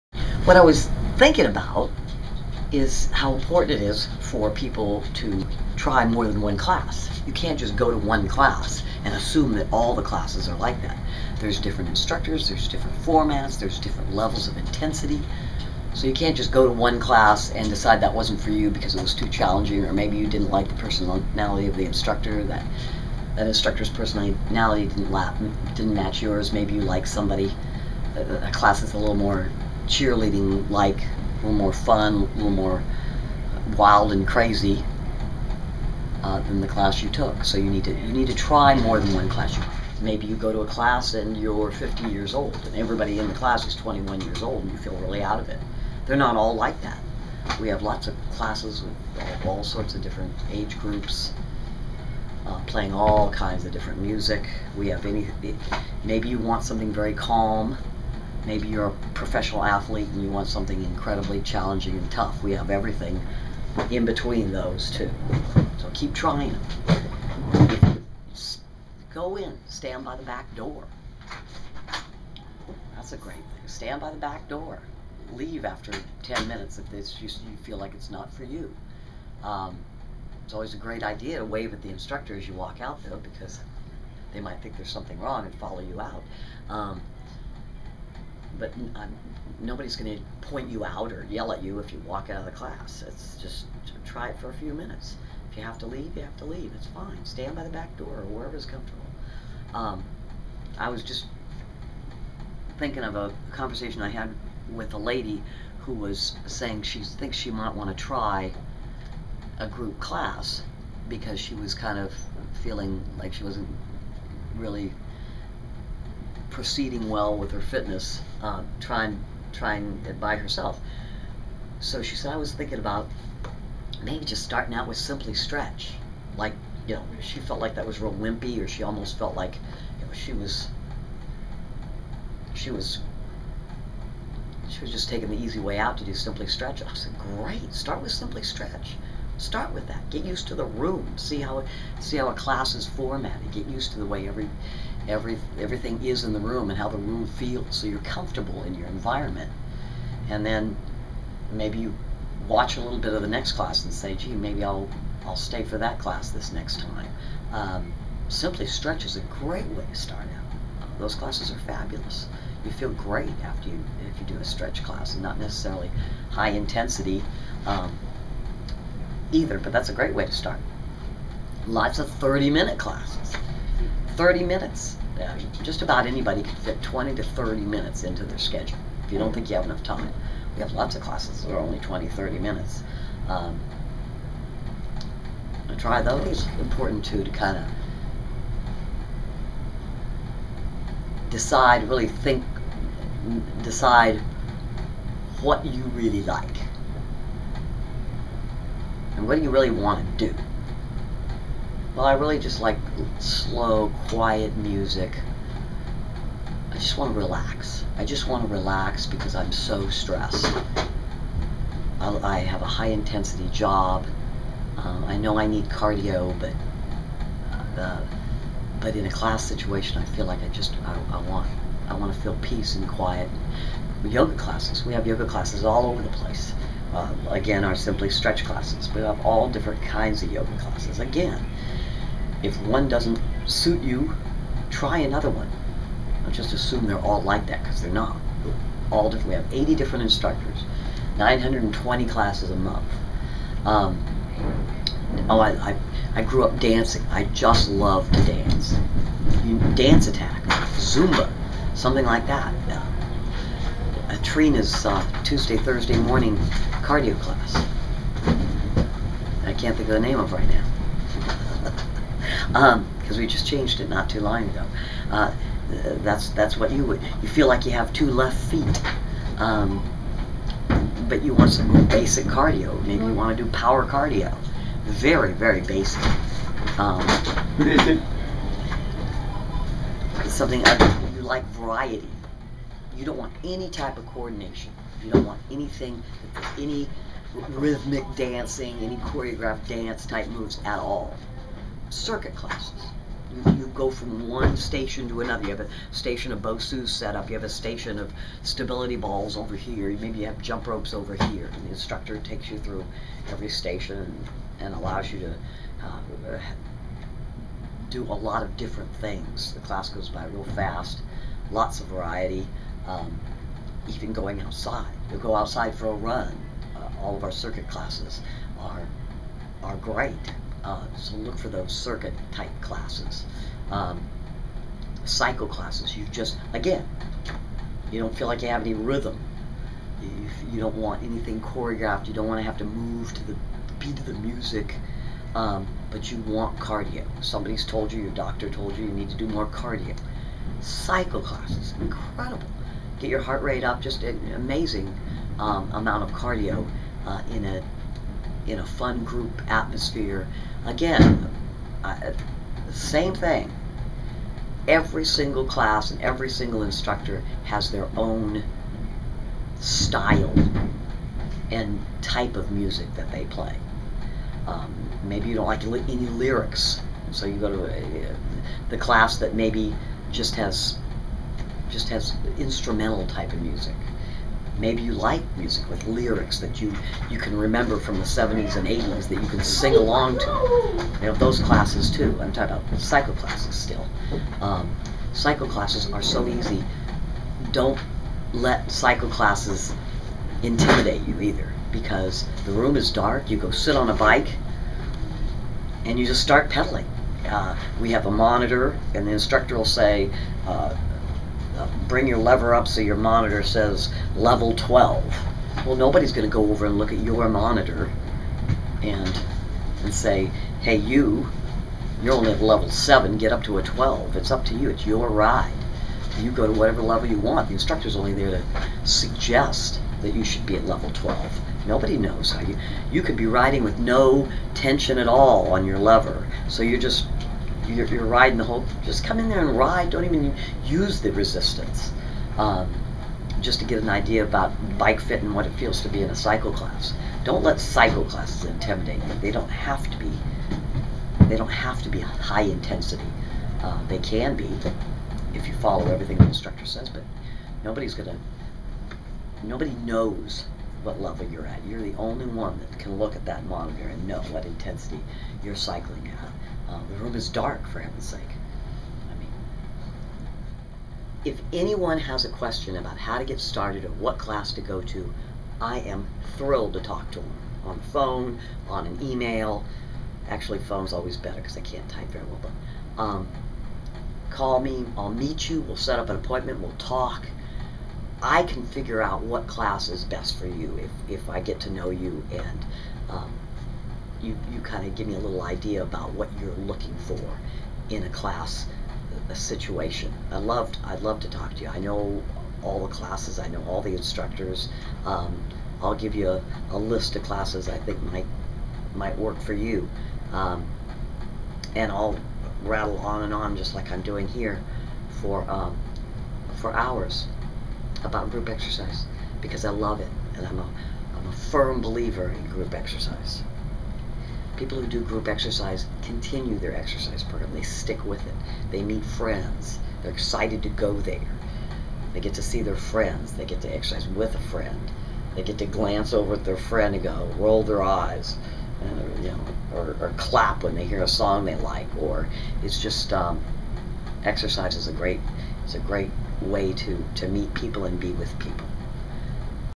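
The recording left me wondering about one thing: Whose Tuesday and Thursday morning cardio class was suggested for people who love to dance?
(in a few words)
Trina.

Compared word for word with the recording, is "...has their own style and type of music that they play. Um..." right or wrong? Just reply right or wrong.
right.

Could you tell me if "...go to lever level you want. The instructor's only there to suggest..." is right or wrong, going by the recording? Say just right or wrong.
wrong.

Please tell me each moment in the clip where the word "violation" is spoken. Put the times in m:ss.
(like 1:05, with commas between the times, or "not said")
not said.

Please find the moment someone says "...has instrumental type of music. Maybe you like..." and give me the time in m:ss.
6:11.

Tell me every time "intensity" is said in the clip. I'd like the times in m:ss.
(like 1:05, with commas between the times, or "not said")
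0:14, 2:46, 3:32, 7:22, 7:34.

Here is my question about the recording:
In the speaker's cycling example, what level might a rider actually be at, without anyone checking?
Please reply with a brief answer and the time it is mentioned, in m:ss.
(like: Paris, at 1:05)
Level 7, at 6:52.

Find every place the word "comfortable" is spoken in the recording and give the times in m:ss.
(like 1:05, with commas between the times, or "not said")
1:38, 2:28.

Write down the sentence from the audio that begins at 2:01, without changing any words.
So she said, I was thinking about maybe just starting out with simply stretch.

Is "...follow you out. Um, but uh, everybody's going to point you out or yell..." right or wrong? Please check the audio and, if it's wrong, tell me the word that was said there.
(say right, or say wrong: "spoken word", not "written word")
wrong: "nobody", not "everybody".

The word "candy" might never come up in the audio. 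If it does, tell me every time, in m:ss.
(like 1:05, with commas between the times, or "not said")
not said.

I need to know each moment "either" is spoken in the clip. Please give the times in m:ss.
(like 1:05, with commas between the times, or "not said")
2:49, 6:31.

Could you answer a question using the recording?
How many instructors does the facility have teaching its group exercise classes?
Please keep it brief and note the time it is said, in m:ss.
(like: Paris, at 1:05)
80, at 3:59.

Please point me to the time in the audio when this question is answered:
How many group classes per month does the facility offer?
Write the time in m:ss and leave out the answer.
4:01.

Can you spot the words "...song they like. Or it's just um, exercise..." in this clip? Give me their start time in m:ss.
8:51.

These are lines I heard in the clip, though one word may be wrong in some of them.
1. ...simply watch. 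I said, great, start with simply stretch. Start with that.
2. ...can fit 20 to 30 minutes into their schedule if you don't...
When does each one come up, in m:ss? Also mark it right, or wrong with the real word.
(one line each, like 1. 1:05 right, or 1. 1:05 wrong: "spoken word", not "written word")
1. 2:16 wrong: "stretch", not "watch"
2. 2:56 right.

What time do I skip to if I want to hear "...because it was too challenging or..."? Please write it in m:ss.
0:18.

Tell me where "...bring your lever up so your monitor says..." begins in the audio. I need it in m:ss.
6:41.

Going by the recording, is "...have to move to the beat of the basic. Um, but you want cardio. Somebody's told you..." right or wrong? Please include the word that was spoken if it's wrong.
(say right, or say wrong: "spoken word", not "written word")
wrong: "music", not "basic".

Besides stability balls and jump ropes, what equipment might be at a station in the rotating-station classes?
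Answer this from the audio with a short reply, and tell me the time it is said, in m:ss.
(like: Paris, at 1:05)
Bosu, at 4:56.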